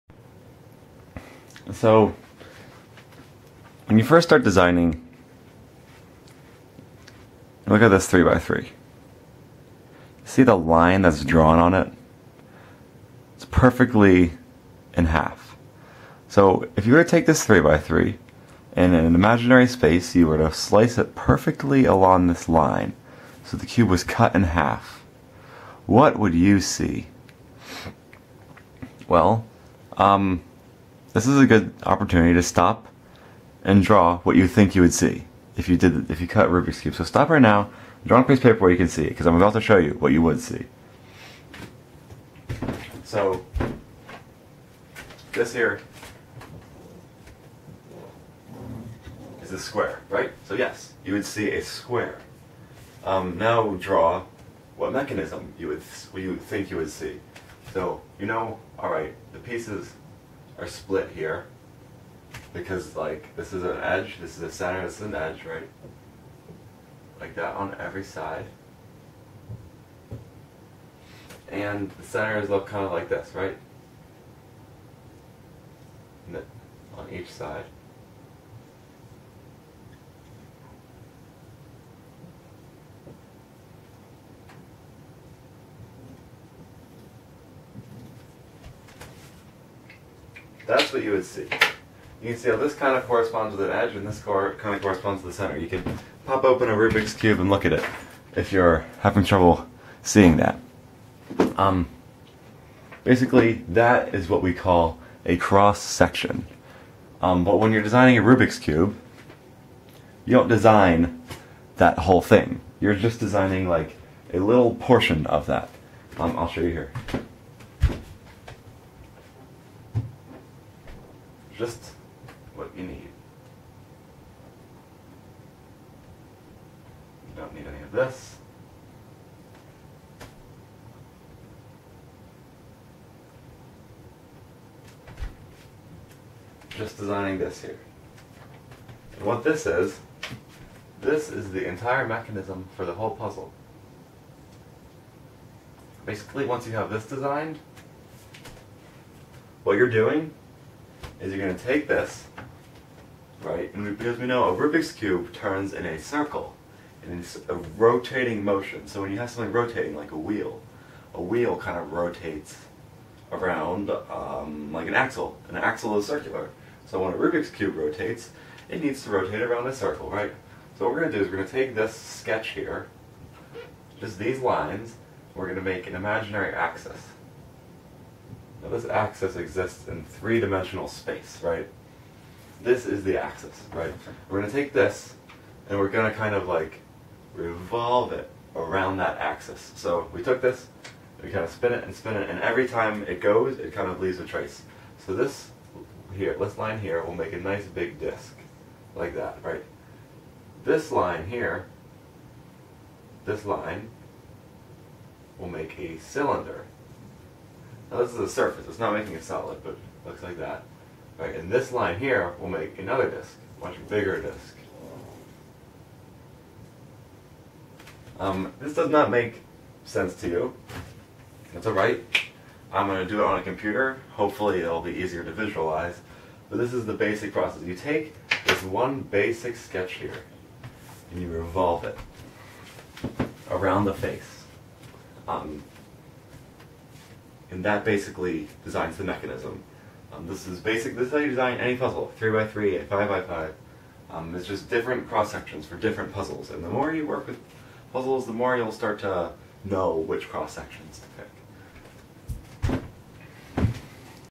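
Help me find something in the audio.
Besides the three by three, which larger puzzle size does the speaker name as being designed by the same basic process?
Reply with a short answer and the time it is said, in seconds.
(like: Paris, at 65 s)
5x5, at 242 s.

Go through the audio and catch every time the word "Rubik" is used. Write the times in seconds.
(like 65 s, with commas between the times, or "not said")
36 s, 96 s, 108 s, 154 s, 167 s.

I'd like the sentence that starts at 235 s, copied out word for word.
Um, and that basically designs the mechanism.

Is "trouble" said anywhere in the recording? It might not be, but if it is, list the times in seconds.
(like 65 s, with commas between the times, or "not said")
99 s.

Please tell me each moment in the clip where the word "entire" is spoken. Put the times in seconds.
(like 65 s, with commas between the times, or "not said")
141 s.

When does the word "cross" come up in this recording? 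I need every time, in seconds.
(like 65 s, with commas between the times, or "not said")
105 s, 245 s, 250 s.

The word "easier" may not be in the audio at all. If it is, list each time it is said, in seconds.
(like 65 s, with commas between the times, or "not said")
224 s.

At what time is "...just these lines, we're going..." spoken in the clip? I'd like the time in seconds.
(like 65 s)
173 s.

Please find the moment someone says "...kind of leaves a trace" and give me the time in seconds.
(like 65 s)
193 s.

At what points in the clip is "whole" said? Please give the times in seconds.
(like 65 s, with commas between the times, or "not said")
111 s, 142 s.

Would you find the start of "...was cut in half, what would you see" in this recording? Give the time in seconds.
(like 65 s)
23 s.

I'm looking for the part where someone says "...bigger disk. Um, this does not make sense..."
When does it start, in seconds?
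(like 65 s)
213 s.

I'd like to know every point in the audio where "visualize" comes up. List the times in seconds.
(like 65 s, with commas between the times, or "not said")
225 s.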